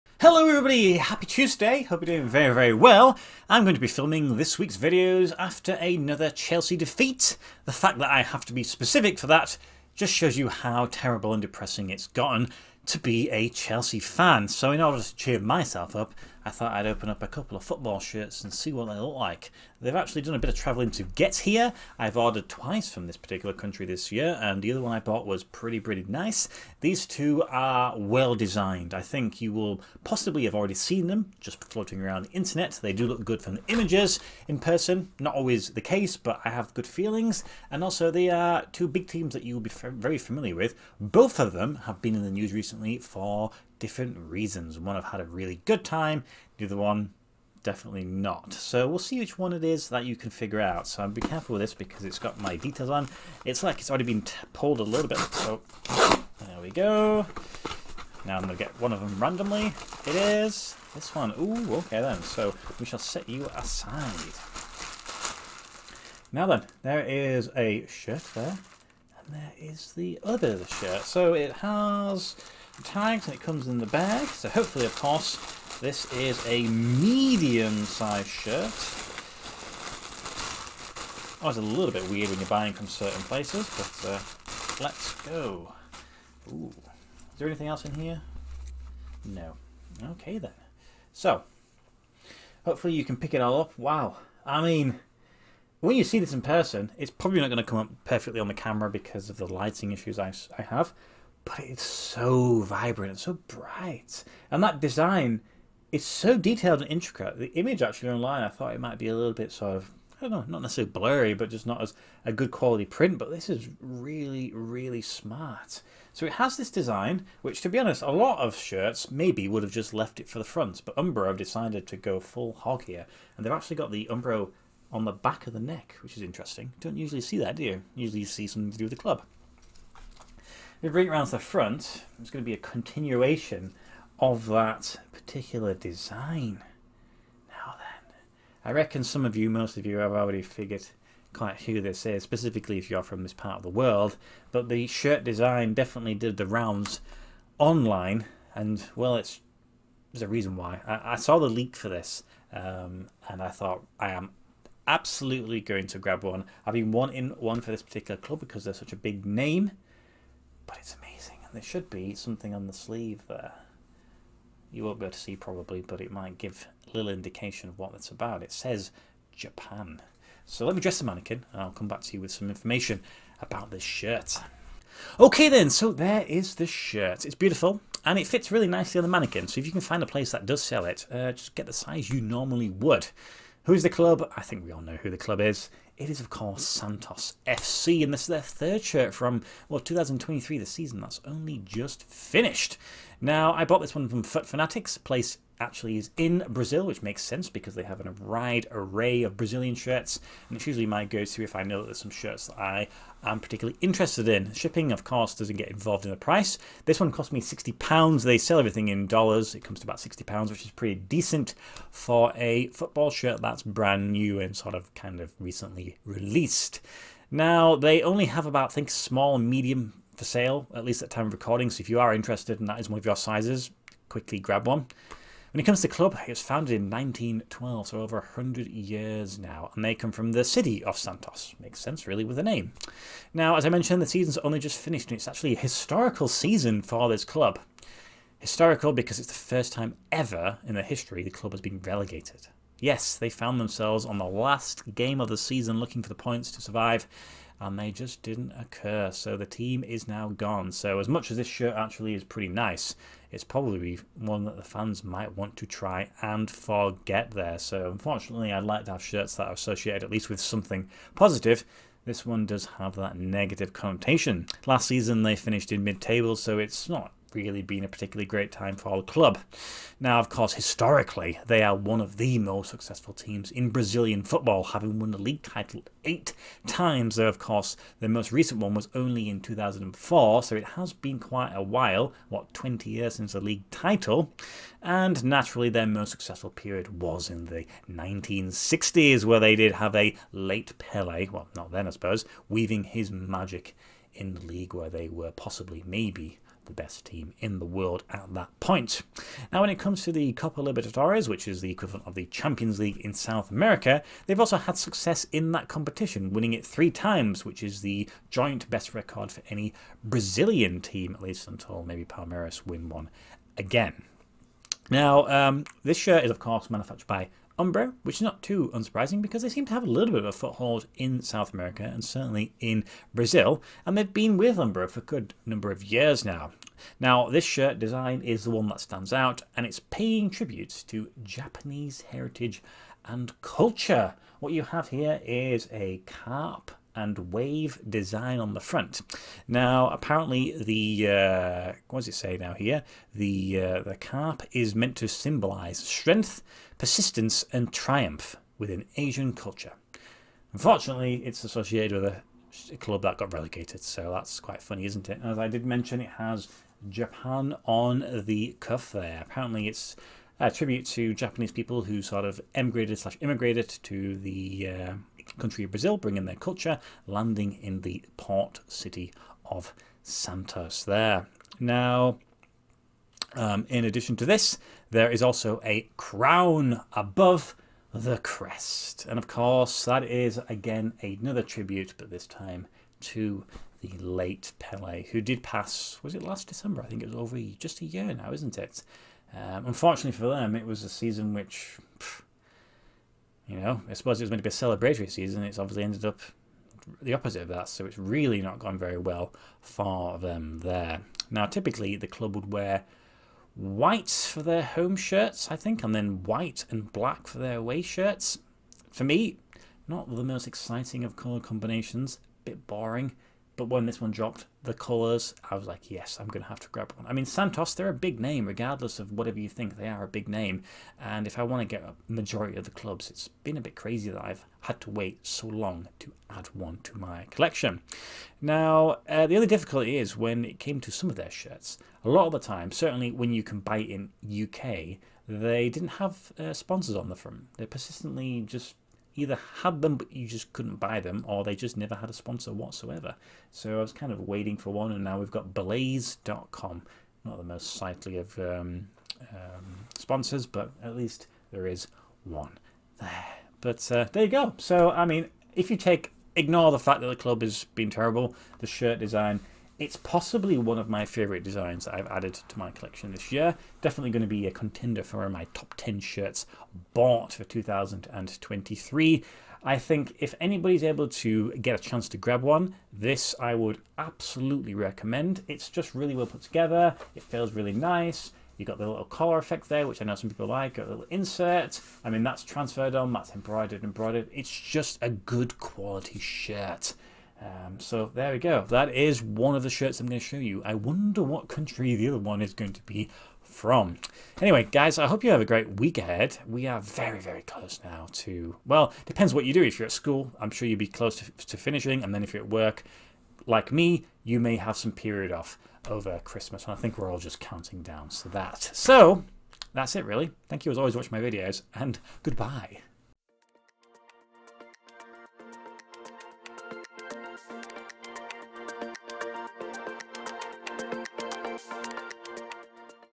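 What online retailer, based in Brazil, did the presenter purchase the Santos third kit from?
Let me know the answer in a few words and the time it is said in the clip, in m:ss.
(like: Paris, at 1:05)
Foot Fanatics, at 3:14.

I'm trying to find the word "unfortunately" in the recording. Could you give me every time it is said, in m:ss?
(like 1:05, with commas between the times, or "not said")
4:17, 5:50, 6:29.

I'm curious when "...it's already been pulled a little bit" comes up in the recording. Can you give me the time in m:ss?
0:53.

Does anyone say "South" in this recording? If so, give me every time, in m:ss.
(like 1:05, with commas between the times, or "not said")
5:03, 5:21.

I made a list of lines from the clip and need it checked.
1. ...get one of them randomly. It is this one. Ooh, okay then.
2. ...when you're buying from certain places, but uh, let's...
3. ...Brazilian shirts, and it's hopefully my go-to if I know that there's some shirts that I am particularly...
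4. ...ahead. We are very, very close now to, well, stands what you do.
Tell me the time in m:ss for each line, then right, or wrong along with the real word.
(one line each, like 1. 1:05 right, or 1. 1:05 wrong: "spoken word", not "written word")
1. 0:58 right
2. 1:22 right
3. 3:19 wrong: "usually", not "hopefully"
4. 8:15 wrong: "depends", not "stands".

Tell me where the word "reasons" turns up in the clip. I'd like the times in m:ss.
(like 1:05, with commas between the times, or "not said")
0:44, 2:30.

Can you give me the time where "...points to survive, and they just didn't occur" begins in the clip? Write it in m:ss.
4:06.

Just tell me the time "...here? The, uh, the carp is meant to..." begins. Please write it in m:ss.
5:42.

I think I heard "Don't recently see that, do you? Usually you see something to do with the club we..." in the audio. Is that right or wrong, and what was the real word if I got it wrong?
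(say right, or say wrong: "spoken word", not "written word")
wrong: "usually", not "recently".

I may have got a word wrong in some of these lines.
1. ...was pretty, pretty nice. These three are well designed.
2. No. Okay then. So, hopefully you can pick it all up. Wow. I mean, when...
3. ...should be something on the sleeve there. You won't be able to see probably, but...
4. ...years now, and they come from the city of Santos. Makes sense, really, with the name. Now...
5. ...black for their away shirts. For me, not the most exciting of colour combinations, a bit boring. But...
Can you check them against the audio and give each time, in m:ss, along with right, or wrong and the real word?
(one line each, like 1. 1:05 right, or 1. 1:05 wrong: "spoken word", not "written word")
1. 0:25 wrong: "two", not "three"
2. 1:29 right
3. 2:41 right
4. 3:48 right
5. 6:46 right.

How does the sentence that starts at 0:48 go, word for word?
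So we'll see which one it is that you can figure out.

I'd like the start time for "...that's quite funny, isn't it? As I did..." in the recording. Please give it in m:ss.
5:54.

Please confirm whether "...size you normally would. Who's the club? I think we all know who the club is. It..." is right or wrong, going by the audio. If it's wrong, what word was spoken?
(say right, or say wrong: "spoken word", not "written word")
right.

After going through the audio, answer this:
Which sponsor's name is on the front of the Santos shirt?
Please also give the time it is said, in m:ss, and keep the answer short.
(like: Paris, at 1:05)
Blaze.com, at 7:25.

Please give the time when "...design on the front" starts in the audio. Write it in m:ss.
5:37.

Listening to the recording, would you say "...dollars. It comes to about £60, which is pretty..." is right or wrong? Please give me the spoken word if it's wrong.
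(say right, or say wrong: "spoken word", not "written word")
right.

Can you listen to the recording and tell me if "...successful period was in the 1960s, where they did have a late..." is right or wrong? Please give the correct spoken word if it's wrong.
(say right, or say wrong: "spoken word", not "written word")
right.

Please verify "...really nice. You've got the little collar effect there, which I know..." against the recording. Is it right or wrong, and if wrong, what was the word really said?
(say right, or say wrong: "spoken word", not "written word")
right.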